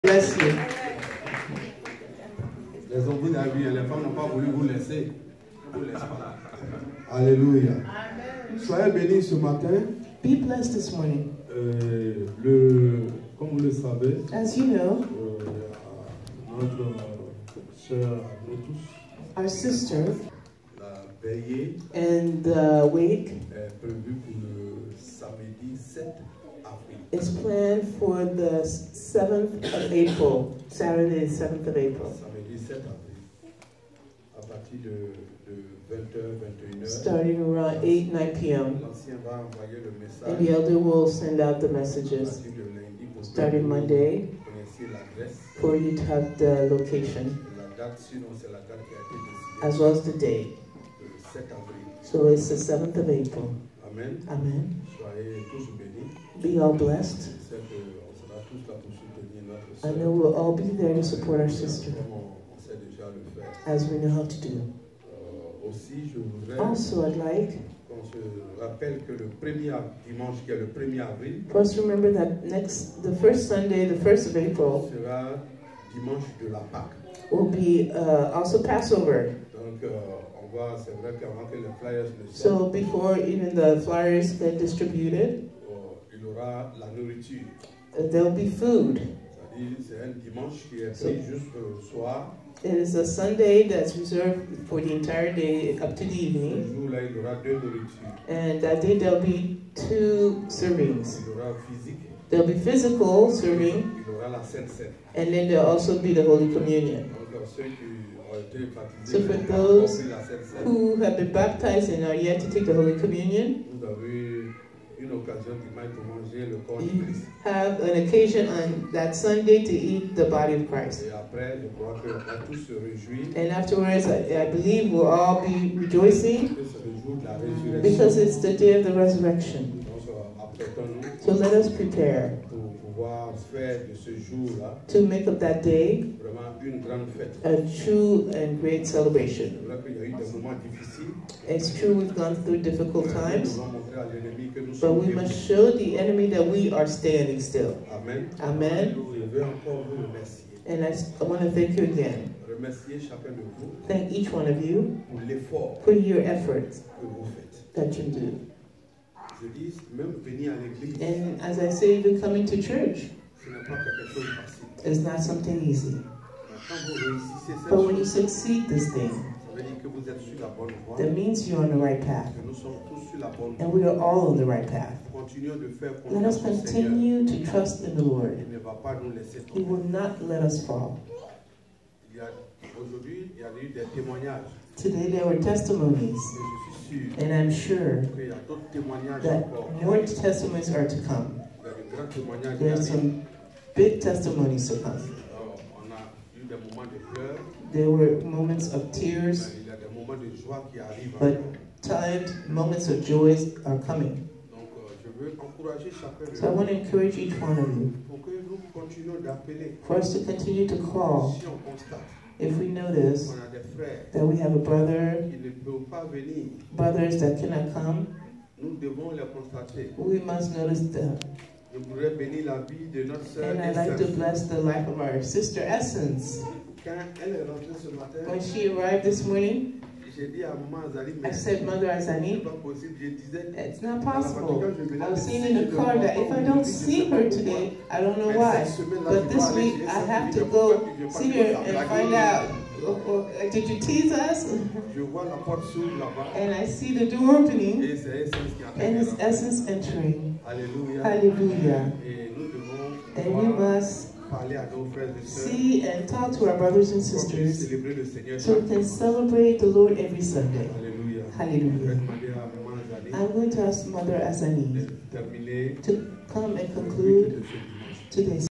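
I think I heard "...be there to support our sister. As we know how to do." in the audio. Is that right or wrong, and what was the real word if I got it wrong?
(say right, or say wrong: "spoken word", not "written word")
right.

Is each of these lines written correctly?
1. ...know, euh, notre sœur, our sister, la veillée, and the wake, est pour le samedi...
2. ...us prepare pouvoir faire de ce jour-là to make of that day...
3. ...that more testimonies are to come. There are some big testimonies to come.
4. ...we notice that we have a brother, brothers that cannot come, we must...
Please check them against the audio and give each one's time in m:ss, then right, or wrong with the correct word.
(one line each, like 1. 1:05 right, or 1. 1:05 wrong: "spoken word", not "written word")
1. 0:14 right
2. 2:11 right
3. 3:08 right
4. 3:32 right.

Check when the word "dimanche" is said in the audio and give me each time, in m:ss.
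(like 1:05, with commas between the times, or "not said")
1:15, 1:30.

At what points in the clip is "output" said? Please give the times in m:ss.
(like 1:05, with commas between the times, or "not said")
not said.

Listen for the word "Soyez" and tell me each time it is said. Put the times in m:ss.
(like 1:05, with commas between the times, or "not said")
0:08, 0:54.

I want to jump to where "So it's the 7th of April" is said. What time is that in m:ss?
0:52.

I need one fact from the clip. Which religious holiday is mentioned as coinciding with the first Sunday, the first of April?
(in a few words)
Passover.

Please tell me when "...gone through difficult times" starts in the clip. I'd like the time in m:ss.
2:22.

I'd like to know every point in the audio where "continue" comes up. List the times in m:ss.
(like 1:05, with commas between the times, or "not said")
2:56, 3:30.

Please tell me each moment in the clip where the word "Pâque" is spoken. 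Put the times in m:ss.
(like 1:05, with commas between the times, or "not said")
1:16.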